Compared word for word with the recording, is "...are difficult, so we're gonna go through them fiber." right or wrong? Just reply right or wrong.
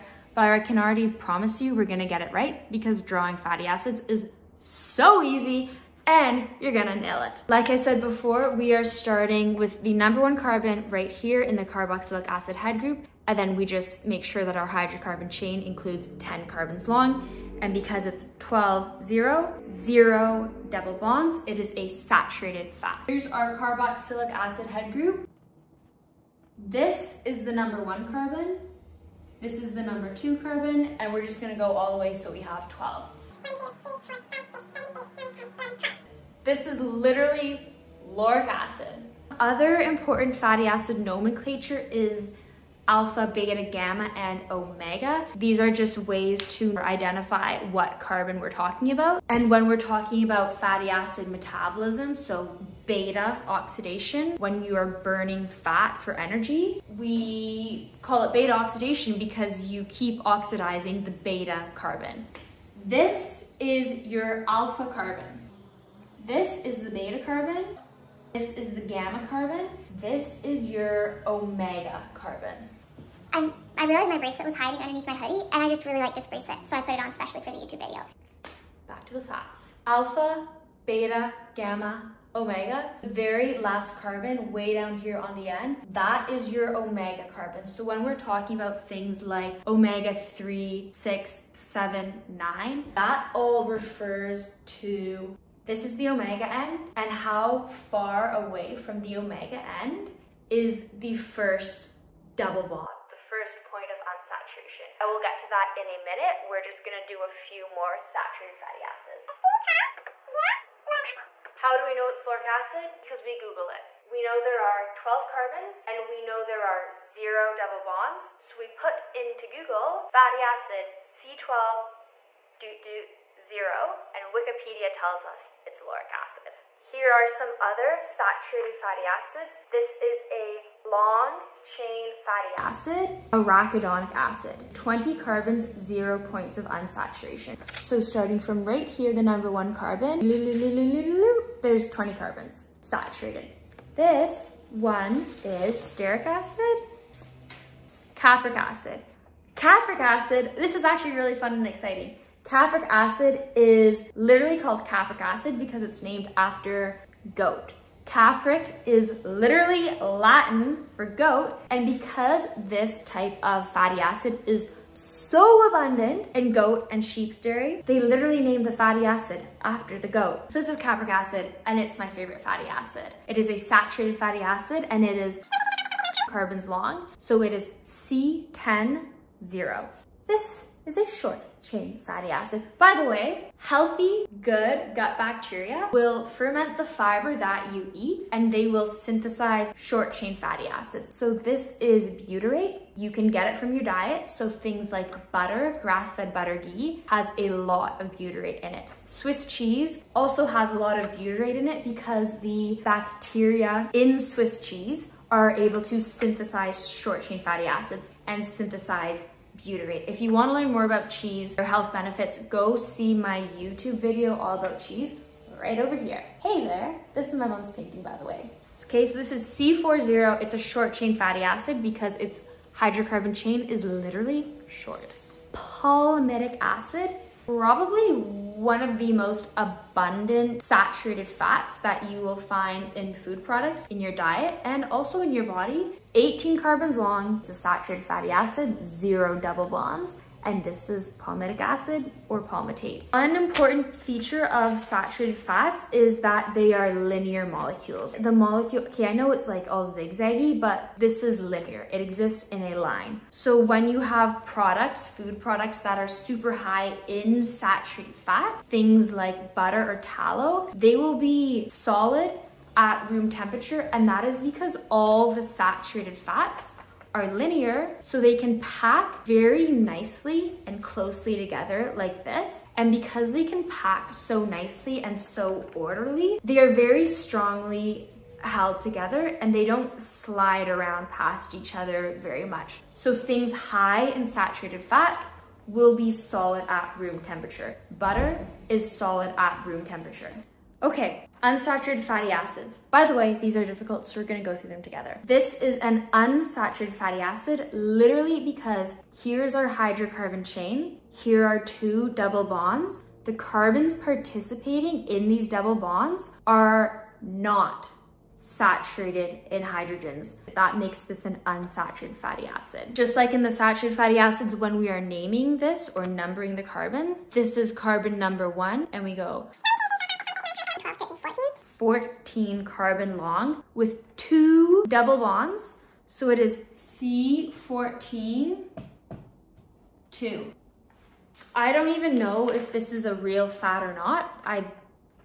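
wrong.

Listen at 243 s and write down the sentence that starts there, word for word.
One important feature of saturated fats is that they are linear molecules.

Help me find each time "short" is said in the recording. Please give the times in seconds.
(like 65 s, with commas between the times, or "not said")
181 s, 189 s, 206 s, 220 s, 224 s.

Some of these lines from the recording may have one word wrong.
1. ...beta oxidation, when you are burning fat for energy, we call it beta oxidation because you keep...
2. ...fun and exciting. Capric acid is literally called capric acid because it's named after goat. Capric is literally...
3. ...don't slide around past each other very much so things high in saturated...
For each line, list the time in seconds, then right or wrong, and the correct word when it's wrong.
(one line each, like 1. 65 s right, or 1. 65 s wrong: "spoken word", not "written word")
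1. 52 s right
2. 151 s right
3. 279 s right.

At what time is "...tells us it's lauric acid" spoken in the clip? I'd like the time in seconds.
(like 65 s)
124 s.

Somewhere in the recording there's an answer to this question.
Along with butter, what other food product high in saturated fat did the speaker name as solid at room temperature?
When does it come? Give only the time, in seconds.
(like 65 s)
259 s.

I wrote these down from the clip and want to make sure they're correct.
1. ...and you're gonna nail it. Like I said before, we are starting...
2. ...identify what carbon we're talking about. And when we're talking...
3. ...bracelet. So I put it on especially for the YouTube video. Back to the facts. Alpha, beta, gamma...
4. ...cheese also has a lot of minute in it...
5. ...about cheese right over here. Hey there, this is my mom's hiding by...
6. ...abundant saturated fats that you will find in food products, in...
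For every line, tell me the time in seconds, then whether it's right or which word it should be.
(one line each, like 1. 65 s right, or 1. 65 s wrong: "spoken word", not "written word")
1. 6 s right
2. 46 s right
3. 76 s right
4. 199 s wrong: "butyrate", not "minute"
5. 214 s wrong: "painting", not "hiding"
6. 229 s right.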